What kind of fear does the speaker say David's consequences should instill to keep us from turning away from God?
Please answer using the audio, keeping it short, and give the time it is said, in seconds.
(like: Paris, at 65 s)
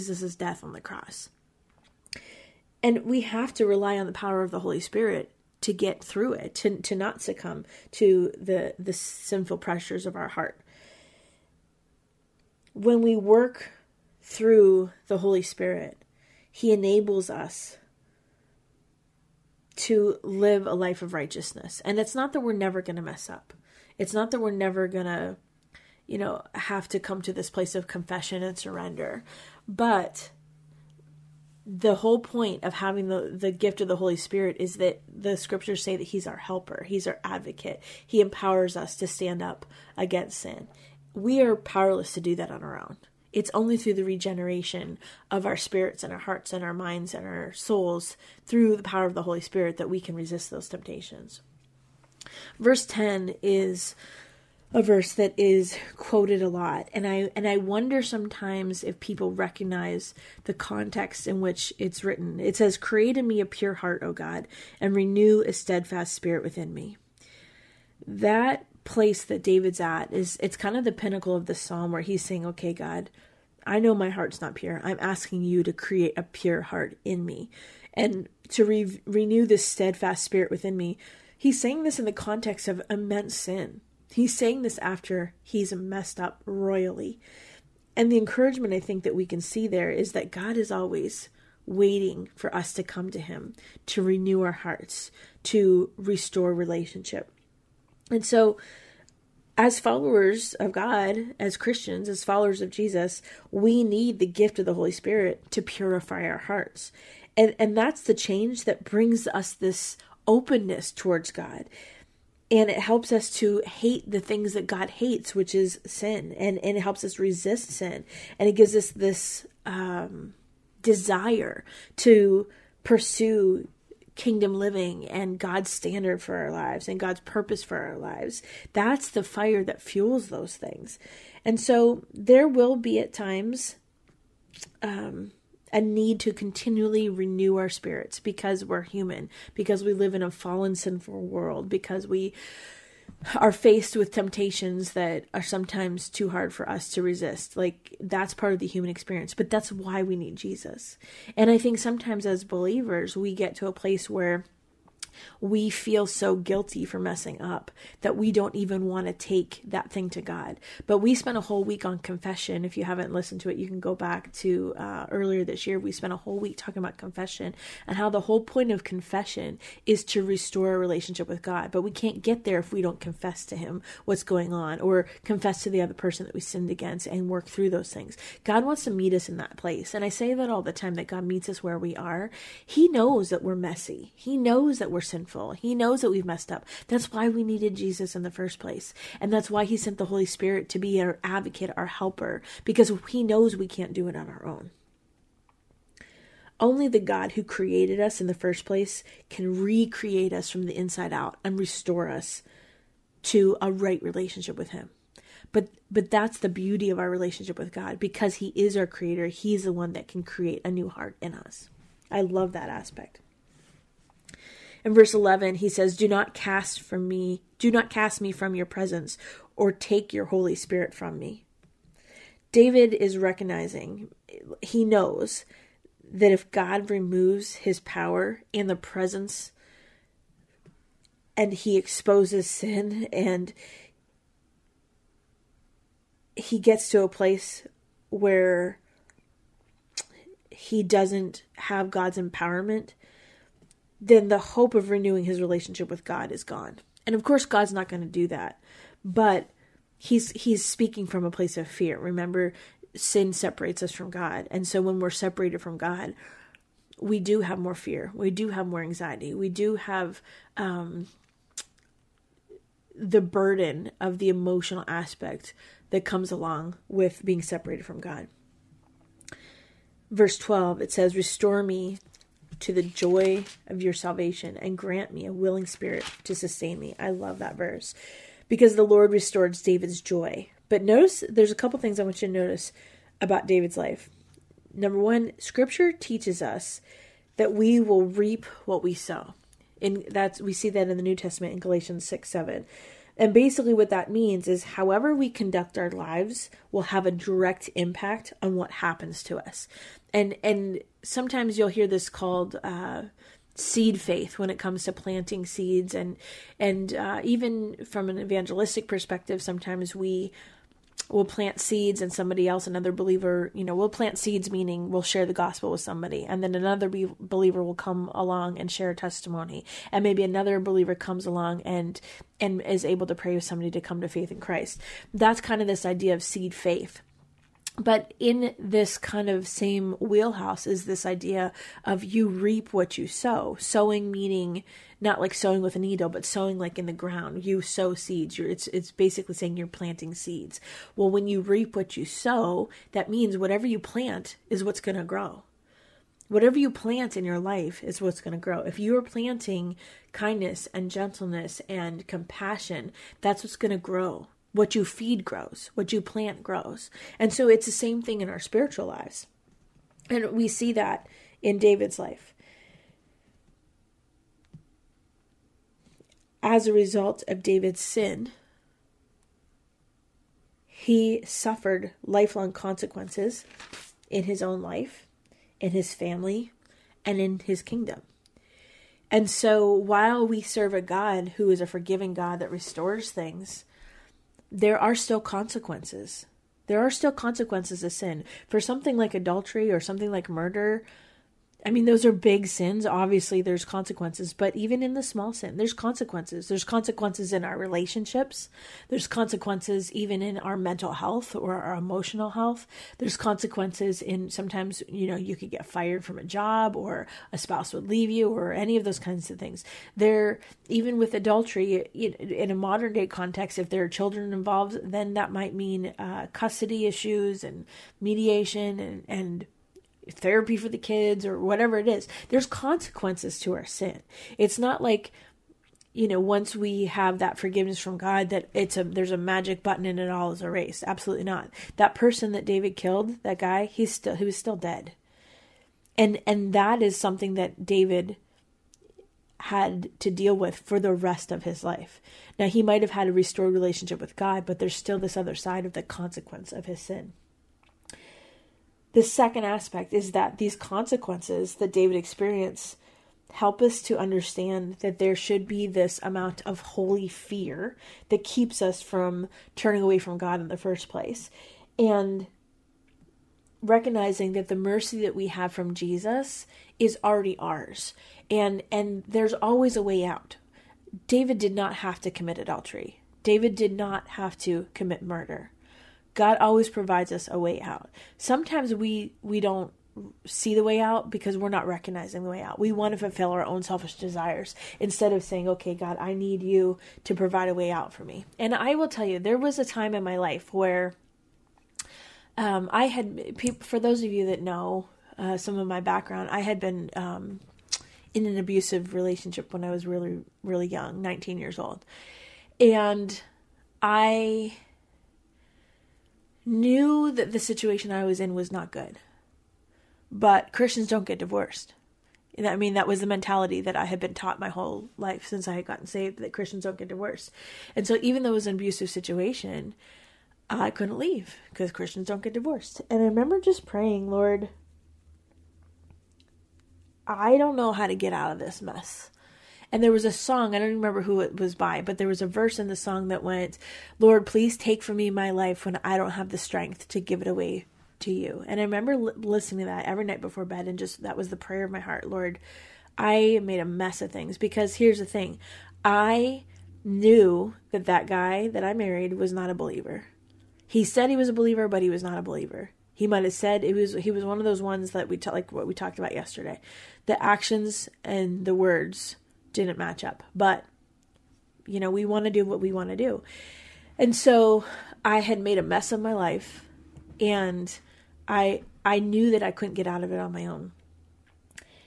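holy fear, at 456 s.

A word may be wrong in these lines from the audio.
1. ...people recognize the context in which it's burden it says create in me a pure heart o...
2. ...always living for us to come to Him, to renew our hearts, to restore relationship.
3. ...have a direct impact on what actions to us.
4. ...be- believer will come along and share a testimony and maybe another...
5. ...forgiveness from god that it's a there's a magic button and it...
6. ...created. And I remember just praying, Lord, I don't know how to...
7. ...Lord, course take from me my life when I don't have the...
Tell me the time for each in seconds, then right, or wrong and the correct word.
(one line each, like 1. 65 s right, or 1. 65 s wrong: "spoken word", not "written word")
1. 58 s wrong: "written", not "burden"
2. 90 s wrong: "waiting", not "living"
3. 296 s wrong: "happens", not "actions"
4. 316 s right
5. 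427 s right
6. 522 s wrong: "divorced", not "created"
7. 533 s wrong: "please", not "course".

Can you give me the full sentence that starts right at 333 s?
Sowing meaning not like sowing with a needle, but sowing like in the ground.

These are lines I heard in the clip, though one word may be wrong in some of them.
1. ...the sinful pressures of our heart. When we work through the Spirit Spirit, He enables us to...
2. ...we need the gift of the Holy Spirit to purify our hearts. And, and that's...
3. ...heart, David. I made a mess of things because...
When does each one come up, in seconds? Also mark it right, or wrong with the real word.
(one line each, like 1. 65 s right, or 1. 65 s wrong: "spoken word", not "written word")
1. 8 s wrong: "Holy", not "Spirit"
2. 103 s right
3. 541 s wrong: "Lord", not "David".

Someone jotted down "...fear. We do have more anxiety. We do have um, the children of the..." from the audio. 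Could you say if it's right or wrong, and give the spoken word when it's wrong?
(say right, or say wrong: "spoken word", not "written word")
wrong: "burden", not "children".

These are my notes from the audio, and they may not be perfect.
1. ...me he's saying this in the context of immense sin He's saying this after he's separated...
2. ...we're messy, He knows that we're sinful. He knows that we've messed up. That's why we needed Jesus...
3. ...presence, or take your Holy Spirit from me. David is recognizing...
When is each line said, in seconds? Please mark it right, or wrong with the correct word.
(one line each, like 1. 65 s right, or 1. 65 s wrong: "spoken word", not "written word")
1. 80 s wrong: "messed", not "separated"
2. 183 s right
3. 218 s right.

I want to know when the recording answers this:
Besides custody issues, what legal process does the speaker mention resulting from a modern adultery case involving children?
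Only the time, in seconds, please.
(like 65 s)
418 s.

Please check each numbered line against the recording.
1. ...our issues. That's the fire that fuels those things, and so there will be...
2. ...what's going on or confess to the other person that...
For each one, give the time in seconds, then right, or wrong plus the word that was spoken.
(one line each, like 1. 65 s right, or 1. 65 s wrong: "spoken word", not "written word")
1. 127 s wrong: "lives", not "issues"
2. 174 s right.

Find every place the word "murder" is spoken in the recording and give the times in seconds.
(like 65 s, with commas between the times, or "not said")
390 s, 475 s.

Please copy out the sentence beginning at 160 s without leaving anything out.
But we spent a whole week on confession.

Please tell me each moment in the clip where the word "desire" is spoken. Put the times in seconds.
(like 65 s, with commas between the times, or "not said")
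120 s, 483 s.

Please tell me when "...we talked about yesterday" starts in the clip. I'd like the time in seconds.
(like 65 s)
555 s.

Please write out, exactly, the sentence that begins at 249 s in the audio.
But he's he's speaking from a place of fear.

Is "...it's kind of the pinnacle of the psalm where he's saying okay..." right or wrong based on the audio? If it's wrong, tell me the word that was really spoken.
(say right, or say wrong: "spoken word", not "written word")
right.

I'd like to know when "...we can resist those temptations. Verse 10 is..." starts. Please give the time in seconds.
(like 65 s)
49 s.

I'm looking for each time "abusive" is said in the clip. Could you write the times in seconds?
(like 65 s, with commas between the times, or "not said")
498 s, 518 s.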